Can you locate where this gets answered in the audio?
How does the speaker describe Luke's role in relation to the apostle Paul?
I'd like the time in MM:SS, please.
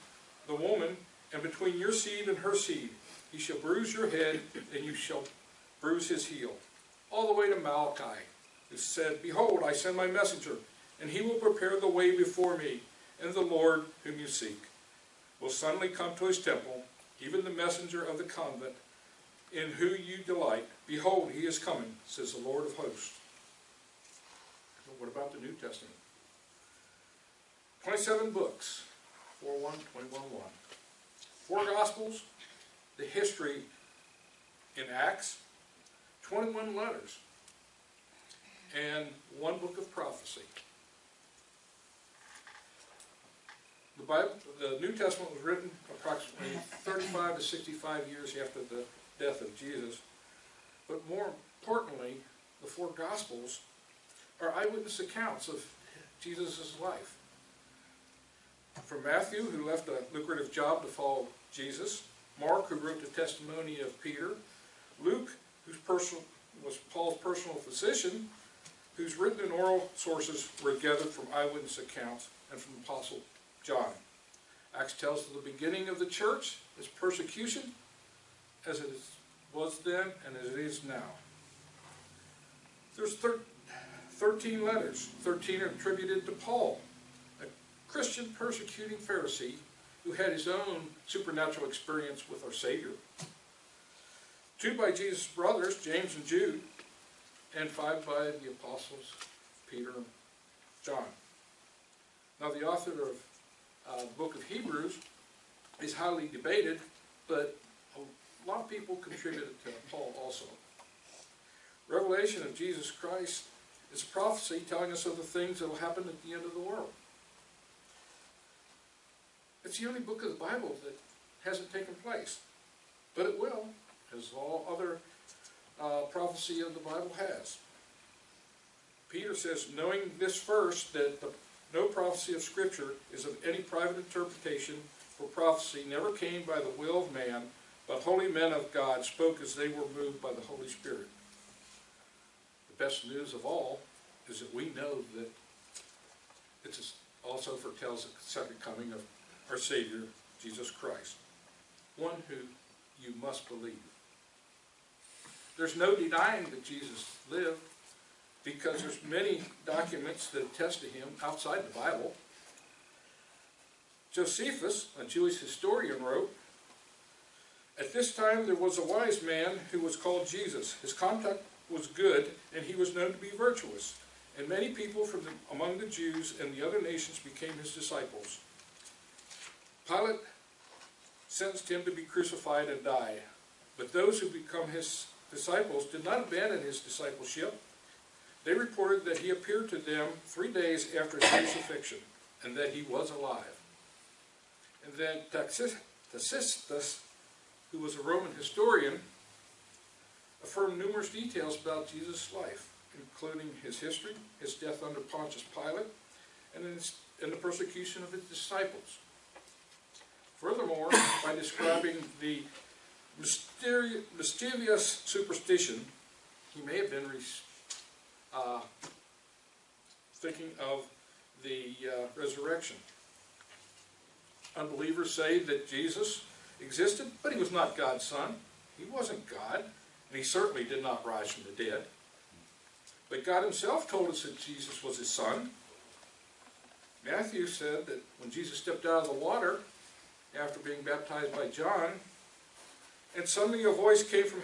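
01:07.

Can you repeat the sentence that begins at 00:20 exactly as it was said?
Behold, he is coming, says the Lord of hosts.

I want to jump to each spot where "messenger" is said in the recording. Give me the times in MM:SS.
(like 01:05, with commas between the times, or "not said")
00:10, 00:17.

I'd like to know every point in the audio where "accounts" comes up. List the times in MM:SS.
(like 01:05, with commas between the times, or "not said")
00:54, 01:11.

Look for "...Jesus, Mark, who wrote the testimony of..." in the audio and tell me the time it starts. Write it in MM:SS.
01:01.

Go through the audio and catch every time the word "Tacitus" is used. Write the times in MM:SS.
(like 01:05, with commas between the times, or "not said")
03:15.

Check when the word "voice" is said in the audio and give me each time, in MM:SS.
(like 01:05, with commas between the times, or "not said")
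04:03.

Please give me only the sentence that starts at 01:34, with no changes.
Two by Jesus' brothers, James and Jude, and five by the apostles, Peter and John.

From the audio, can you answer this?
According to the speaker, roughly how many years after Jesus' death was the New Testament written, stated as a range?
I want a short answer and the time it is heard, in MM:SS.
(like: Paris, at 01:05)
35 to 65, at 00:46.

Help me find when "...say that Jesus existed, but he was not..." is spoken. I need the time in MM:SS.
03:45.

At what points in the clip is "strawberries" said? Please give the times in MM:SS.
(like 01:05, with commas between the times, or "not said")
not said.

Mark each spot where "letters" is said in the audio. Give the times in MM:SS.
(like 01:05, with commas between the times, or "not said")
00:36, 01:24.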